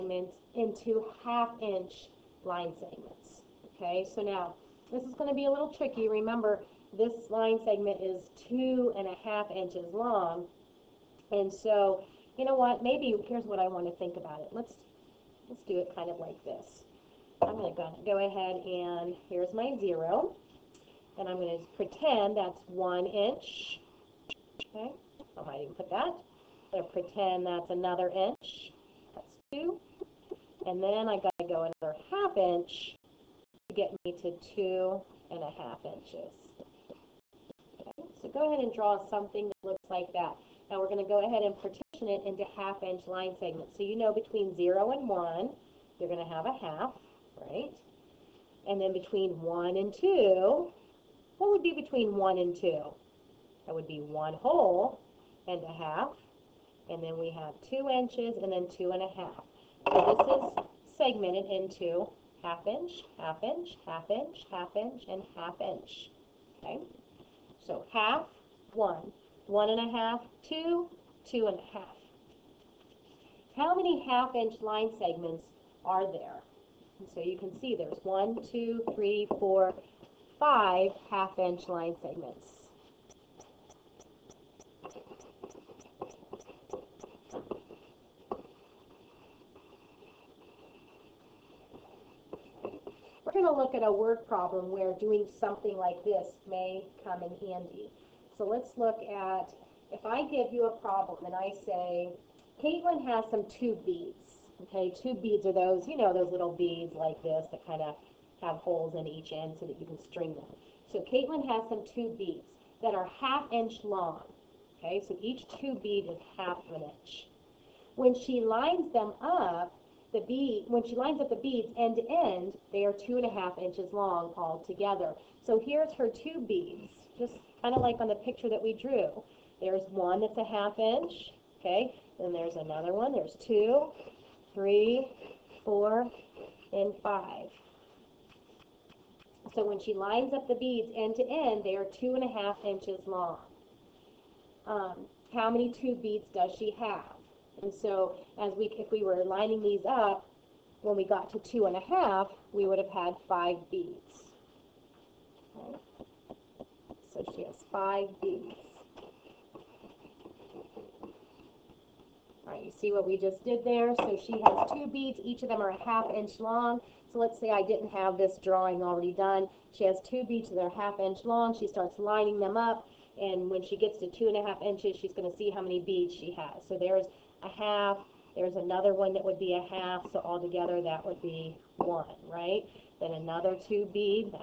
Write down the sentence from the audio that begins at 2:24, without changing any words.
Um, how many two beads does she have?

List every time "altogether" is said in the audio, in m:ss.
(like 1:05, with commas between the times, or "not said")
3:00.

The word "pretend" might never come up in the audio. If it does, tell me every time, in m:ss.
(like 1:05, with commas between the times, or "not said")
0:21, 0:26.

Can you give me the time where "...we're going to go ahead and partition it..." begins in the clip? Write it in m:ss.
0:40.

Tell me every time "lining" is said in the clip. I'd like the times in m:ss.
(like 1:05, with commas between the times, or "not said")
2:29, 2:51.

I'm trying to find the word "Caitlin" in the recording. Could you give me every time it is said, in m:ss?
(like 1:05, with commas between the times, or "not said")
1:42, 1:51.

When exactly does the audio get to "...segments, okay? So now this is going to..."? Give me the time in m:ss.
0:02.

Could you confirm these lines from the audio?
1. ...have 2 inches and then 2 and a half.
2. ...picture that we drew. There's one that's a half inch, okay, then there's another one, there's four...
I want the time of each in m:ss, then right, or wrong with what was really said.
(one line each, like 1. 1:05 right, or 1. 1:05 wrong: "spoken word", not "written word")
1. 0:57 right
2. 2:08 wrong: "two", not "four".